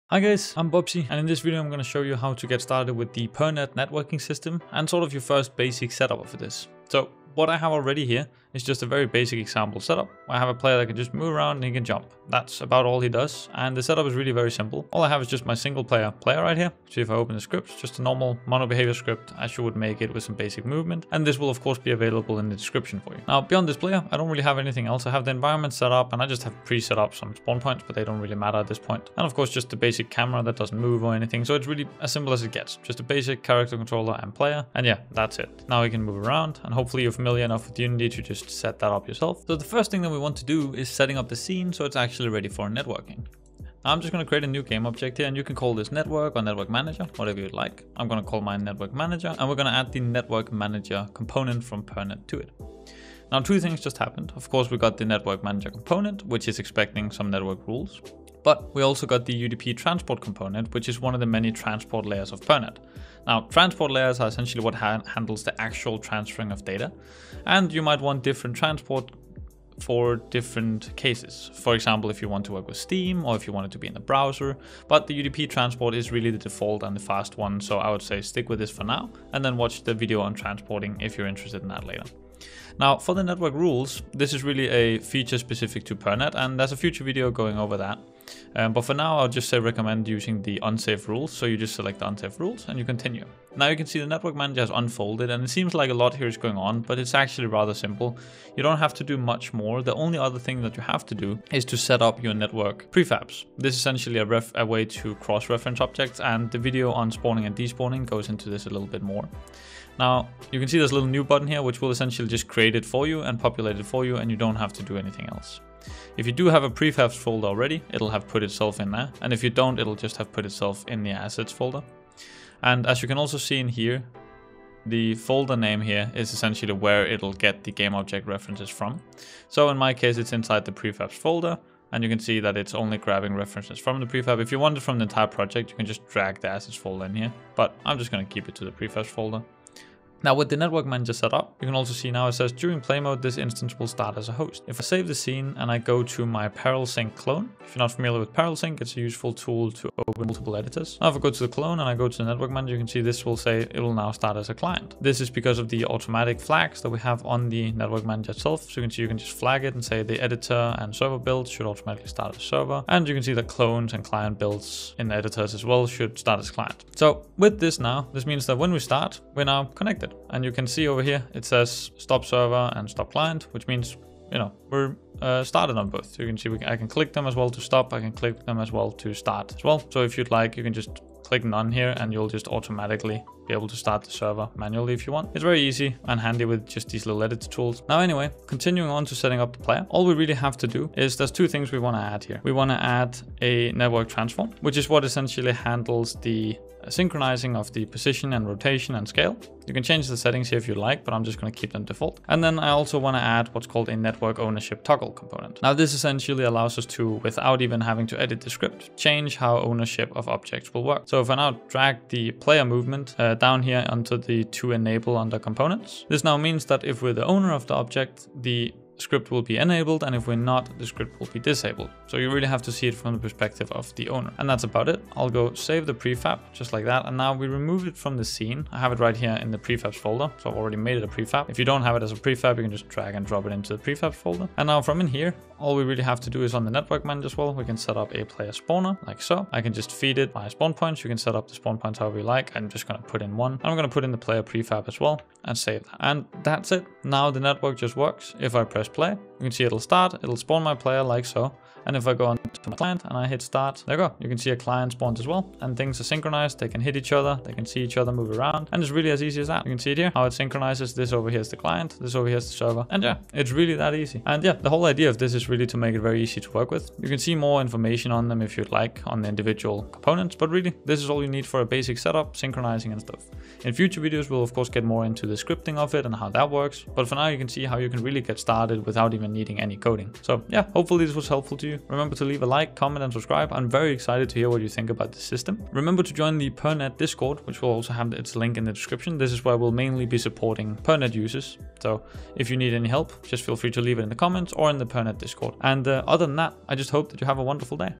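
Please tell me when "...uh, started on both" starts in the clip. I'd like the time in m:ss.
2:55.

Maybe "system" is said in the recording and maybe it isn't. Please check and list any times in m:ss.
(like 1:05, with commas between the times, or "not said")
0:04, 4:45.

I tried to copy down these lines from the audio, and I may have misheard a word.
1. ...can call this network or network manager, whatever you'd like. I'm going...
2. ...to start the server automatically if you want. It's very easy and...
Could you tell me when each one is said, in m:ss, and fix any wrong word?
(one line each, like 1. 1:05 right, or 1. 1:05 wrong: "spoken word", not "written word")
1. 0:45 right
2. 3:03 wrong: "manually", not "automatically".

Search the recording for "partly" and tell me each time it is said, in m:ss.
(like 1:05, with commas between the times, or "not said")
not said.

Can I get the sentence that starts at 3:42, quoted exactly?
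So you really have to see it from the perspective of the owner.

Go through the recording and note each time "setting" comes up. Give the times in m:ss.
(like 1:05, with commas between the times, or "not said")
0:40, 3:09, 3:20.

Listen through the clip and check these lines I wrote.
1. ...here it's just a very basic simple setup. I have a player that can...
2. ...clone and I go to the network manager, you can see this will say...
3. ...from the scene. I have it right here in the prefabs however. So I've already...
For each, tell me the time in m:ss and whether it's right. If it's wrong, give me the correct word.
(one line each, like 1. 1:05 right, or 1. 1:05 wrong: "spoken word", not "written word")
1. 0:08 wrong: "example", not "simple"
2. 2:31 right
3. 3:47 wrong: "folder", not "however".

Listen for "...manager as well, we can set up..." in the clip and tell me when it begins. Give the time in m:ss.
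3:57.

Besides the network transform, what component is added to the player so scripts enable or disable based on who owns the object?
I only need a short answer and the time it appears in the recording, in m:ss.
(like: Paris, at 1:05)
Network ownership toggle, at 3:23.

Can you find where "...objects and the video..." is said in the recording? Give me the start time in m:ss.
1:45.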